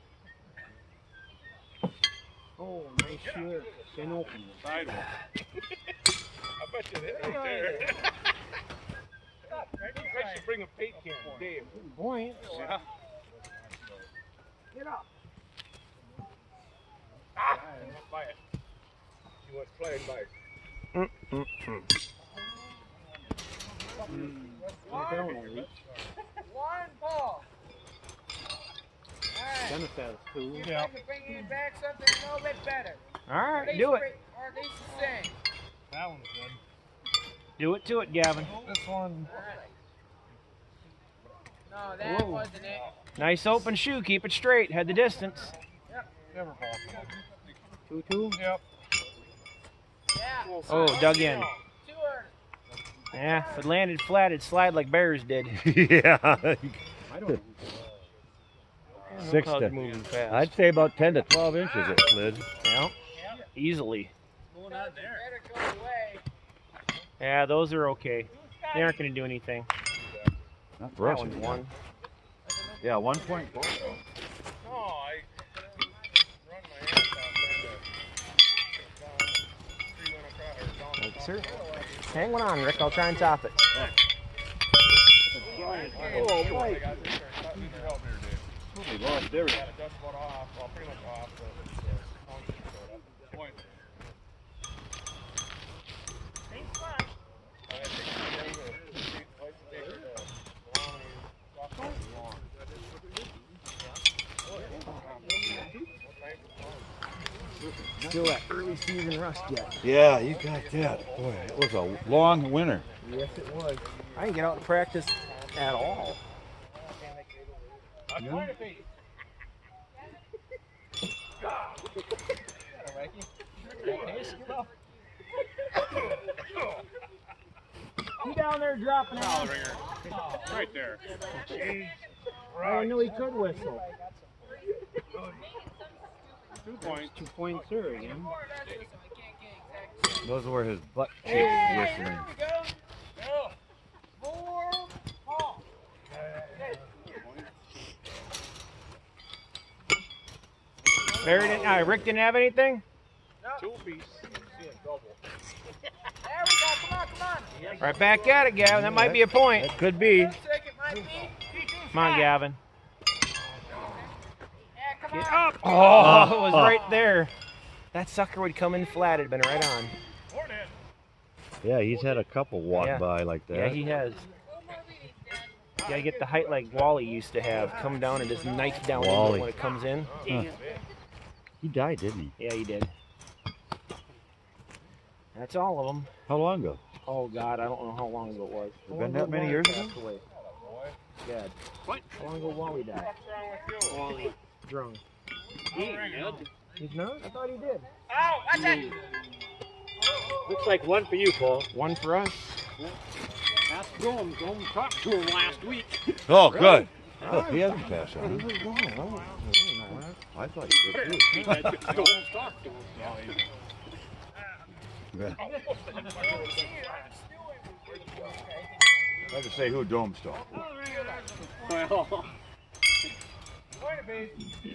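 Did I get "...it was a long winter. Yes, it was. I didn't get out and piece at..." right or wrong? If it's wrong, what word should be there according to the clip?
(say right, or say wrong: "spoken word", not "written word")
wrong: "practice", not "piece".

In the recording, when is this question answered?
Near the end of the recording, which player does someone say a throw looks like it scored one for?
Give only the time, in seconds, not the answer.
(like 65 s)
201 s.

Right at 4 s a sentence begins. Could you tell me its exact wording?
I bet you hit right there.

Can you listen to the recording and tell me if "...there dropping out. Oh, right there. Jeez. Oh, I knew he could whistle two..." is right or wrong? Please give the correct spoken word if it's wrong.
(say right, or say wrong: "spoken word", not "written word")
right.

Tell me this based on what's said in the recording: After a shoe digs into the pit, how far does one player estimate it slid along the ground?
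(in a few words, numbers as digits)
10 to 12 inches.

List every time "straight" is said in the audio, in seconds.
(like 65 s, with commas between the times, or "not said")
44 s.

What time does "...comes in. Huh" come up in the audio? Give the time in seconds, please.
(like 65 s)
179 s.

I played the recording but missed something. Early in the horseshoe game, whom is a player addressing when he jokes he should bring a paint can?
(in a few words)
Dave.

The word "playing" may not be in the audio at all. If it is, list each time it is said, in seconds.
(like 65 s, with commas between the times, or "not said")
19 s.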